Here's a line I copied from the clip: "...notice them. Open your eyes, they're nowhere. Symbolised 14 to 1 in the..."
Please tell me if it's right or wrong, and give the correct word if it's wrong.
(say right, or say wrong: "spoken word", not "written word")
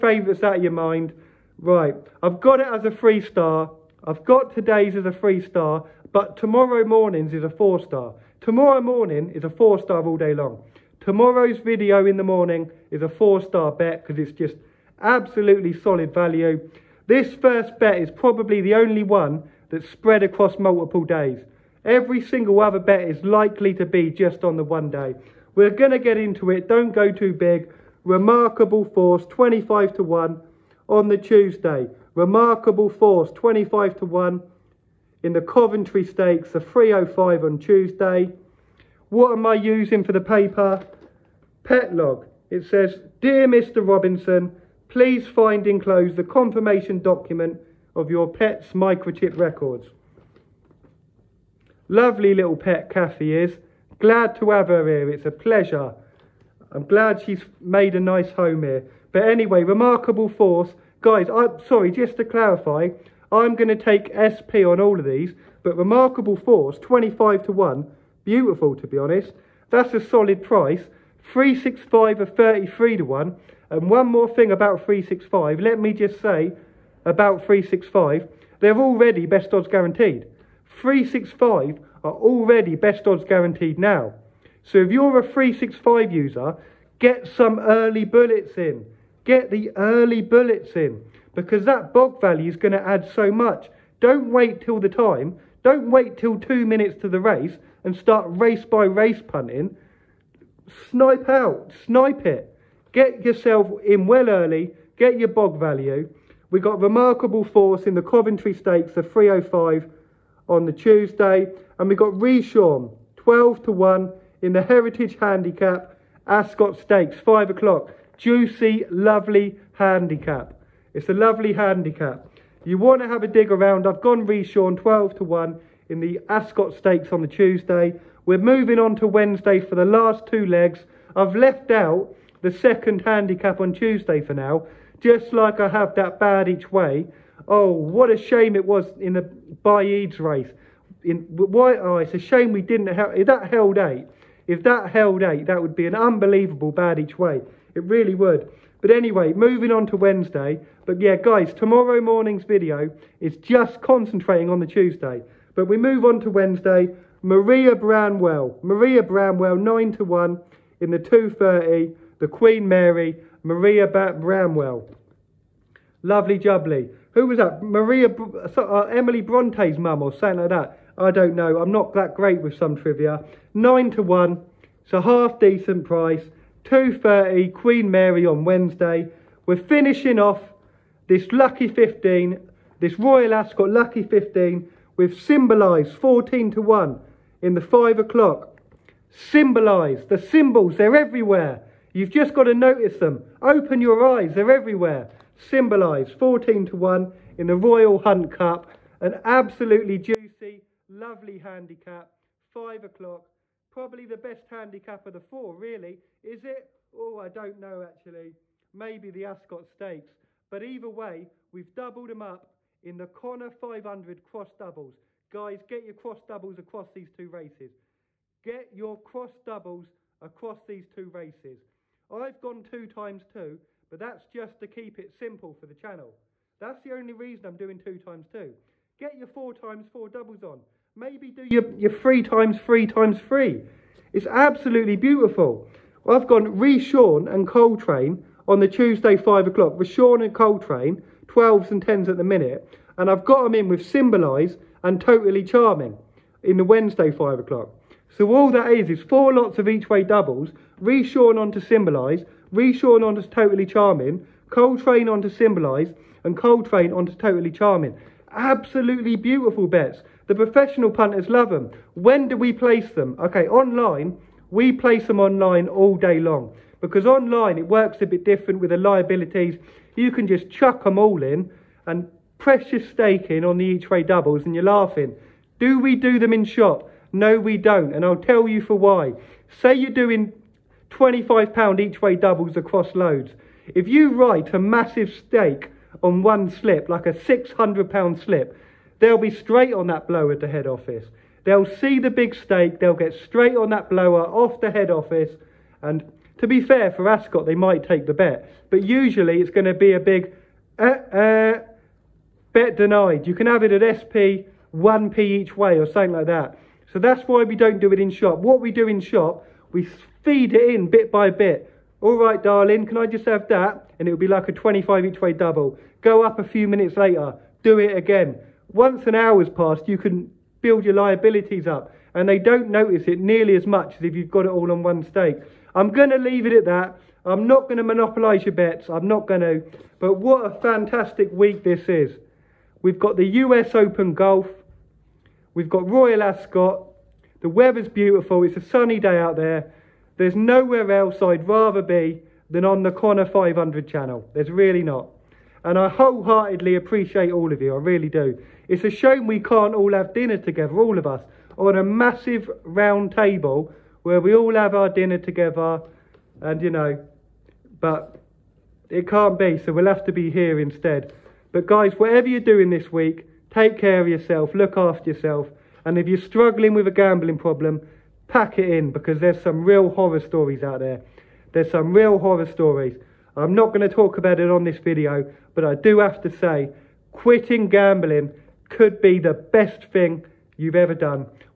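wrong: "everywhere", not "nowhere".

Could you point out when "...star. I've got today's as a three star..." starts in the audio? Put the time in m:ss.
0:03.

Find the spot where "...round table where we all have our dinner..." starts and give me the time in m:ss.
5:52.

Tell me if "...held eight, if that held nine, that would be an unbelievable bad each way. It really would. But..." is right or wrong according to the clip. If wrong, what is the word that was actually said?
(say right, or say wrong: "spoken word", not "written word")
wrong: "eight", not "nine".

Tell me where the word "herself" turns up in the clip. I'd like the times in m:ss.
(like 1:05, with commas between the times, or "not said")
not said.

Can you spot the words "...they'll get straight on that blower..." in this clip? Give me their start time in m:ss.
4:52.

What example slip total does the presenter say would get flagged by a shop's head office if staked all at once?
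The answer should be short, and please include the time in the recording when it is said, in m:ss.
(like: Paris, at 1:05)
£600, at 4:47.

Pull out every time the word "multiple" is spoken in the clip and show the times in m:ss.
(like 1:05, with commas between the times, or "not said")
0:20.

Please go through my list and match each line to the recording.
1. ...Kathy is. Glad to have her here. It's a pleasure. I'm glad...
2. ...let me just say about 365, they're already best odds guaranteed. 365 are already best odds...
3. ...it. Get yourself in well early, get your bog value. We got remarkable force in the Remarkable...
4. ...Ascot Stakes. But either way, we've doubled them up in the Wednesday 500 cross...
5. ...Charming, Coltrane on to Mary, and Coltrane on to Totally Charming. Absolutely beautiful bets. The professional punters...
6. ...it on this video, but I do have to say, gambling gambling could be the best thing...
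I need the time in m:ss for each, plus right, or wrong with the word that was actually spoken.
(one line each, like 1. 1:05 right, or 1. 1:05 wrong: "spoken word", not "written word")
1. 0:52 right
2. 1:15 right
3. 1:42 wrong: "Coventry", not "Remarkable"
4. 3:29 wrong: "Connor", not "Wednesday"
5. 4:13 wrong: "Symbolize", not "Mary"
6. 6:14 wrong: "quitting", not "gambling".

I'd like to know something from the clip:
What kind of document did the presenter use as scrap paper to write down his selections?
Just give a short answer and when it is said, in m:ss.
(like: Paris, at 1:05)
Pet log, at 0:41.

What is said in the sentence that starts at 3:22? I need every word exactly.
5 o'clock, Probably the best handicap of the four, really.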